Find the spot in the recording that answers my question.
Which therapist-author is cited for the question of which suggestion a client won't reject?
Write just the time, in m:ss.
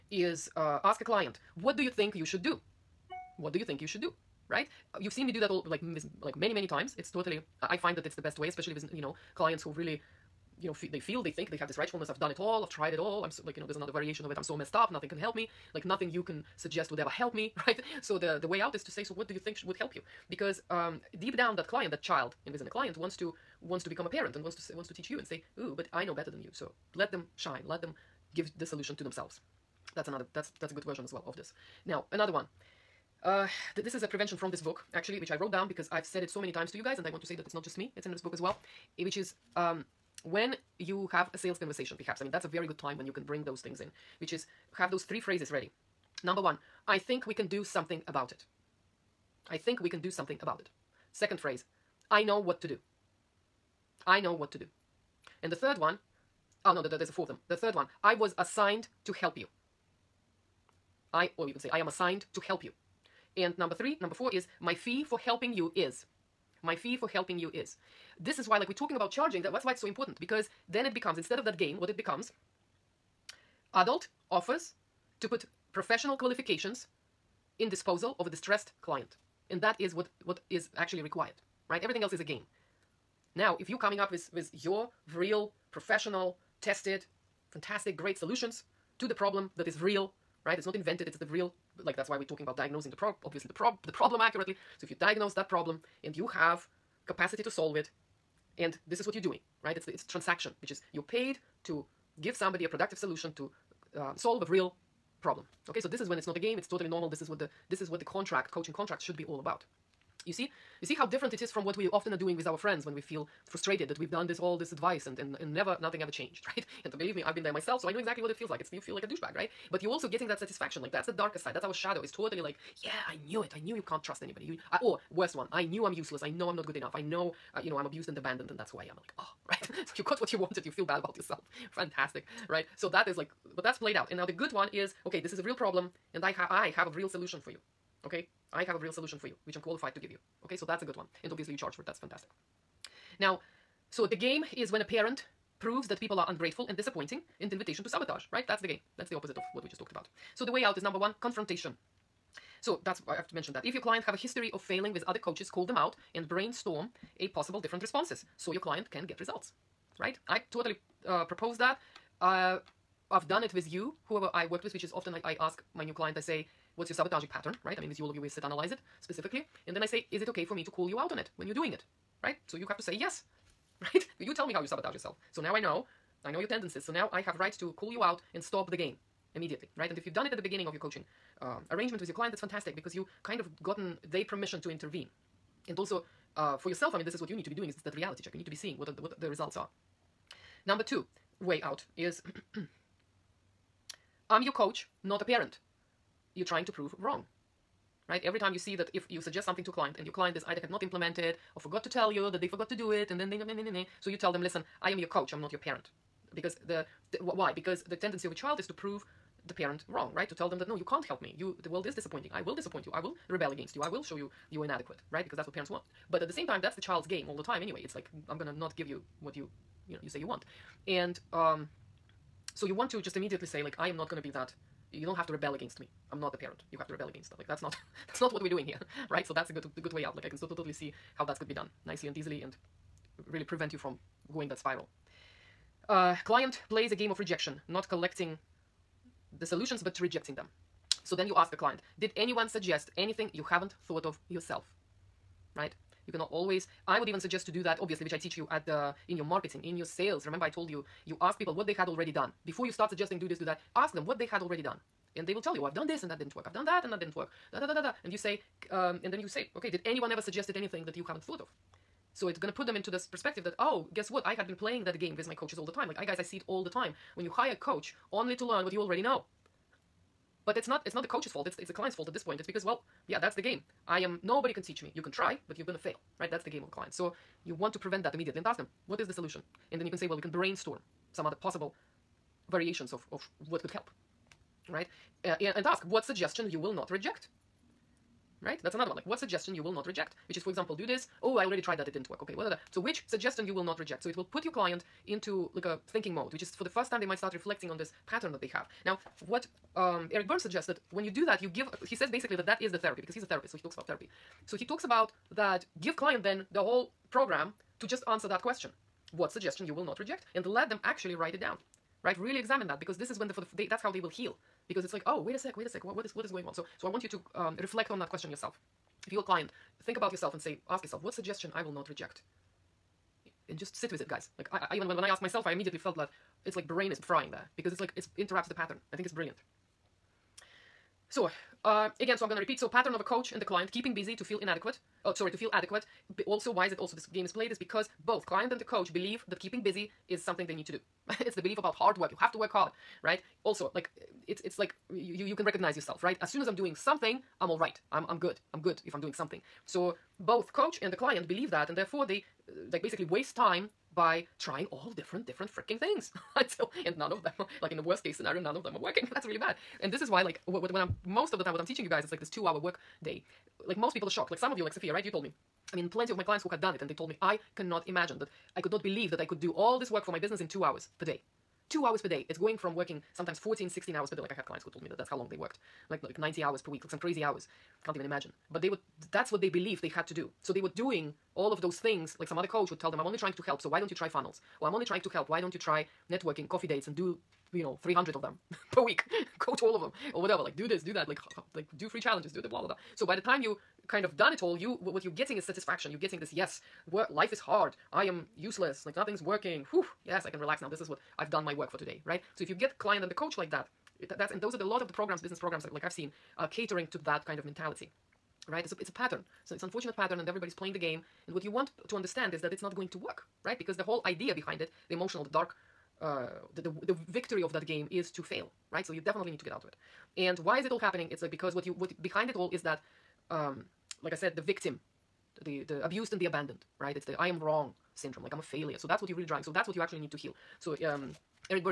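5:00.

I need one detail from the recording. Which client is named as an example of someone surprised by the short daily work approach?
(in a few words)
Sophia.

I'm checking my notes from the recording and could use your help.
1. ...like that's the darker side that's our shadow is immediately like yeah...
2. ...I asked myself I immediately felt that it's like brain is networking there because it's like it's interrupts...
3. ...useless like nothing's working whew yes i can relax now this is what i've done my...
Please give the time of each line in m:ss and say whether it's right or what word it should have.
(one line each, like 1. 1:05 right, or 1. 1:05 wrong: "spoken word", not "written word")
1. 2:00 wrong: "totally", not "immediately"
2. 5:25 wrong: "frying", not "networking"
3. 6:38 right.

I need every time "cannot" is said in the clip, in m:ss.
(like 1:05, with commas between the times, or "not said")
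4:06, 6:07.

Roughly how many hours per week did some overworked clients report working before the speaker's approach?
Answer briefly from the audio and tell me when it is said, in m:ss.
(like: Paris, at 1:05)
90, at 6:16.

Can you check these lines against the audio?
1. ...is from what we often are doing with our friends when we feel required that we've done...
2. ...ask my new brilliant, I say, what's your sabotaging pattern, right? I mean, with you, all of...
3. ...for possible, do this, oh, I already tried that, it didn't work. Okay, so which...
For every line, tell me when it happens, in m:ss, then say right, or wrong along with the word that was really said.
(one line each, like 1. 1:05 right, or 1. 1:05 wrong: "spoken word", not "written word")
1. 1:51 wrong: "frustrated", not "required"
2. 2:45 wrong: "client", not "brilliant"
3. 4:50 wrong: "example", not "possible".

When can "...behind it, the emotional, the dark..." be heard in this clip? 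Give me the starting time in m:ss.
6:54.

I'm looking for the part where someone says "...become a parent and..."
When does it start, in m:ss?
0:23.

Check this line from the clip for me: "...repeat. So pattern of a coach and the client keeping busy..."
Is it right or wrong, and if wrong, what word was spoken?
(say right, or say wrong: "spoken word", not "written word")
right.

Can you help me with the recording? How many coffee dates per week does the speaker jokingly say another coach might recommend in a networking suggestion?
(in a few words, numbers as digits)
300.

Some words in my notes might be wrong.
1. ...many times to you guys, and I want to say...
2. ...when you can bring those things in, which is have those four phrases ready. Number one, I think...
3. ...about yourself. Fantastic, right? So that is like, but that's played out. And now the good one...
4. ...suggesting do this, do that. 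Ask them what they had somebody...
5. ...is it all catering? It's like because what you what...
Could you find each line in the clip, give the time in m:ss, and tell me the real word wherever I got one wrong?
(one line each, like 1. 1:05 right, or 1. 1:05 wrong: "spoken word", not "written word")
1. 0:36 right
2. 0:42 wrong: "three", not "four"
3. 2:10 right
4. 4:12 wrong: "already", not "somebody"
5. 7:00 wrong: "happening", not "catering".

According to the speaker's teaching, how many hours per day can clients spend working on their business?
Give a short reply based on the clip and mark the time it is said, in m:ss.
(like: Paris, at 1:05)
2, at 6:02.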